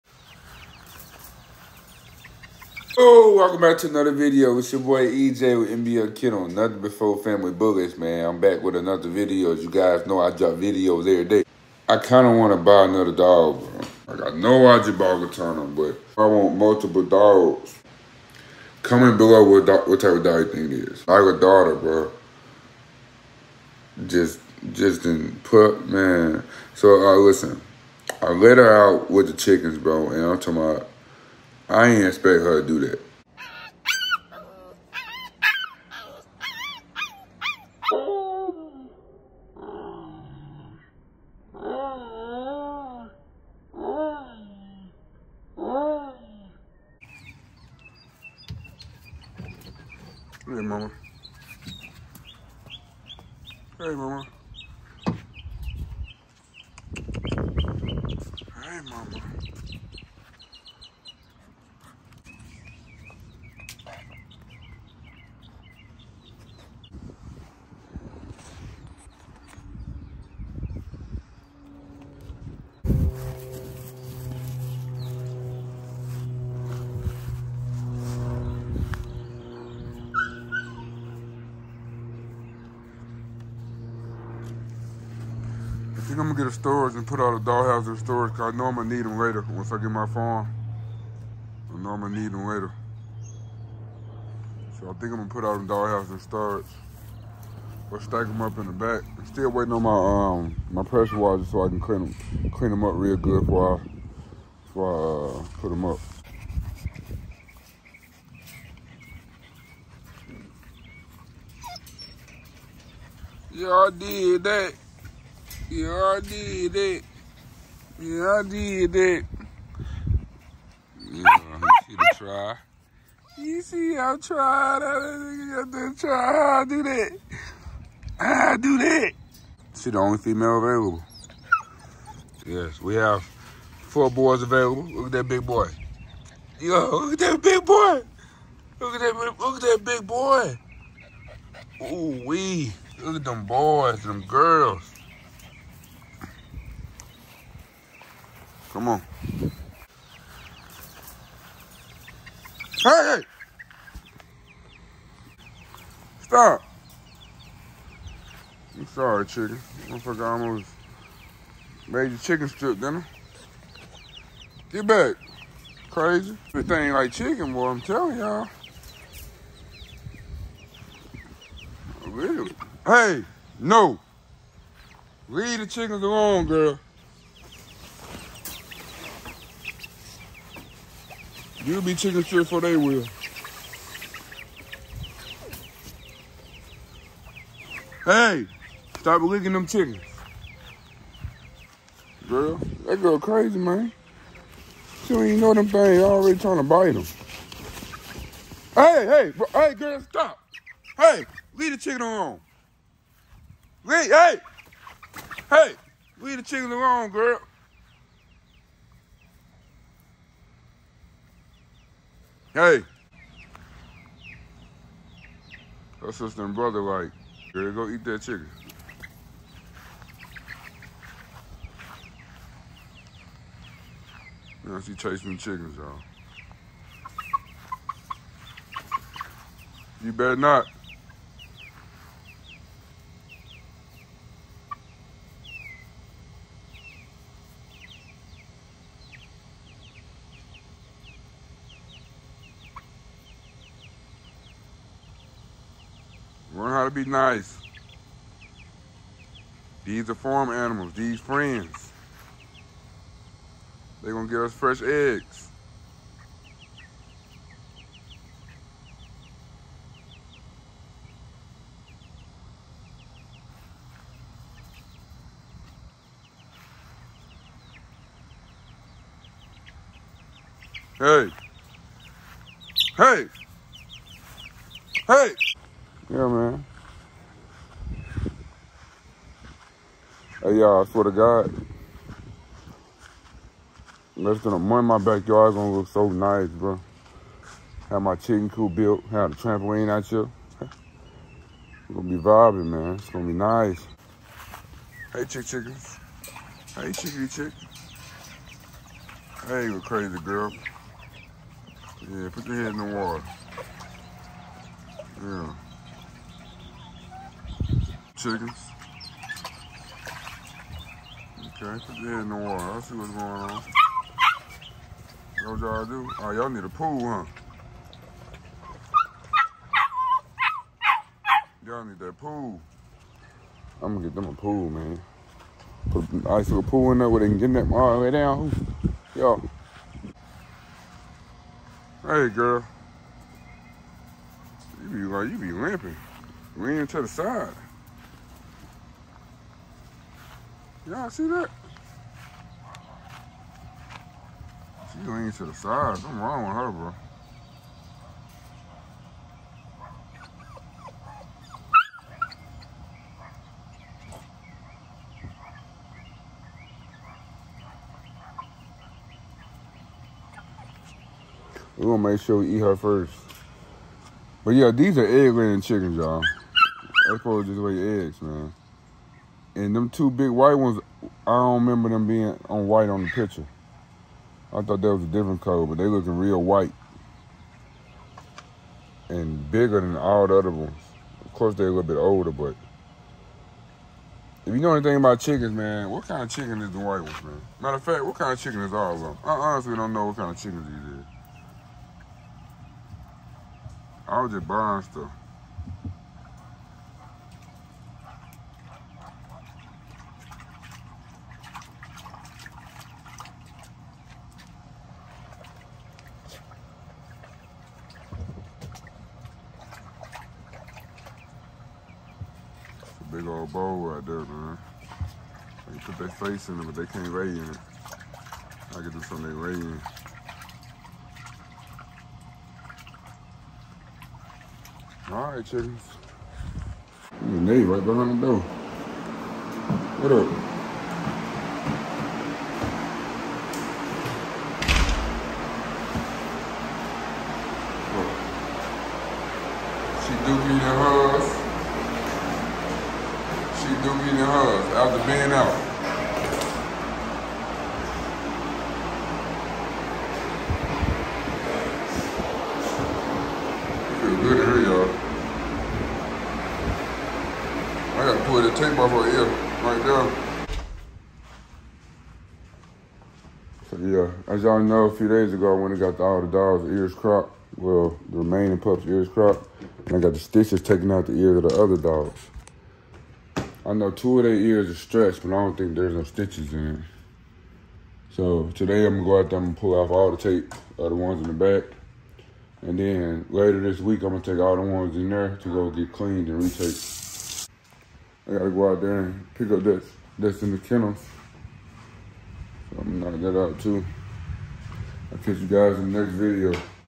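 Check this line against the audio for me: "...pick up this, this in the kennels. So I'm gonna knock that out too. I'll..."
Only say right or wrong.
right.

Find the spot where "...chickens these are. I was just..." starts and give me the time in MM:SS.
06:30.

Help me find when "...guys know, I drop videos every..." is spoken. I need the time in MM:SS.
00:09.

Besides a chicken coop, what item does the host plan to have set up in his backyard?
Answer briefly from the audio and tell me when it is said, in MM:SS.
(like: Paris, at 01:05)
Trampoline, at 04:49.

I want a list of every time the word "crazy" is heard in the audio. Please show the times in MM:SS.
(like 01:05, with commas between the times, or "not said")
02:45, 03:13, 04:59.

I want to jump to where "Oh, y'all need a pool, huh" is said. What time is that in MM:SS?
05:16.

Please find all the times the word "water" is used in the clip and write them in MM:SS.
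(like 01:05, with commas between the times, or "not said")
05:02, 05:12.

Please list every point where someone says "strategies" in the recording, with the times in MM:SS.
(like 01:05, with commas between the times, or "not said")
not said.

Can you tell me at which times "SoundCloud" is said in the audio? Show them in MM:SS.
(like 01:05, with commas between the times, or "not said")
not said.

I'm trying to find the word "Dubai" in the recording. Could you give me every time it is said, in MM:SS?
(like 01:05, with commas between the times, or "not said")
not said.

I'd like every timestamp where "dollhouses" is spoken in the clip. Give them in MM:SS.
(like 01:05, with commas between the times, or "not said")
01:27, 01:35.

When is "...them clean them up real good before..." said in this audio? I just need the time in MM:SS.
01:42.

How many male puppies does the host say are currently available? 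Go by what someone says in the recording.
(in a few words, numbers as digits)
4.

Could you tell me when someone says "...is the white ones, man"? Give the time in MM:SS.
06:26.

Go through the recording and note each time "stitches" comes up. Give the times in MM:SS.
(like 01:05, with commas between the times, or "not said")
07:50, 07:56.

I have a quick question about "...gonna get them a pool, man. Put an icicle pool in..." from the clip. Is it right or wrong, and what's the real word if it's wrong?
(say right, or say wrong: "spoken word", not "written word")
right.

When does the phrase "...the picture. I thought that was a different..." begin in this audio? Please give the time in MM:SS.
06:13.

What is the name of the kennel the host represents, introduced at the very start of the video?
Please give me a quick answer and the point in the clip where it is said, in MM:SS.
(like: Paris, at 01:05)
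NBF Kennel, at 00:05.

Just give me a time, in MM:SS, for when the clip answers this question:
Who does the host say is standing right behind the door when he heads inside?
07:07.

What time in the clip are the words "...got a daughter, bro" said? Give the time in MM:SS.
00:21.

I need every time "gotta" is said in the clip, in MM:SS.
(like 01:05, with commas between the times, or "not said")
07:38, 08:08.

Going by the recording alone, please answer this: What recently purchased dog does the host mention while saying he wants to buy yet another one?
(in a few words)
Gatana.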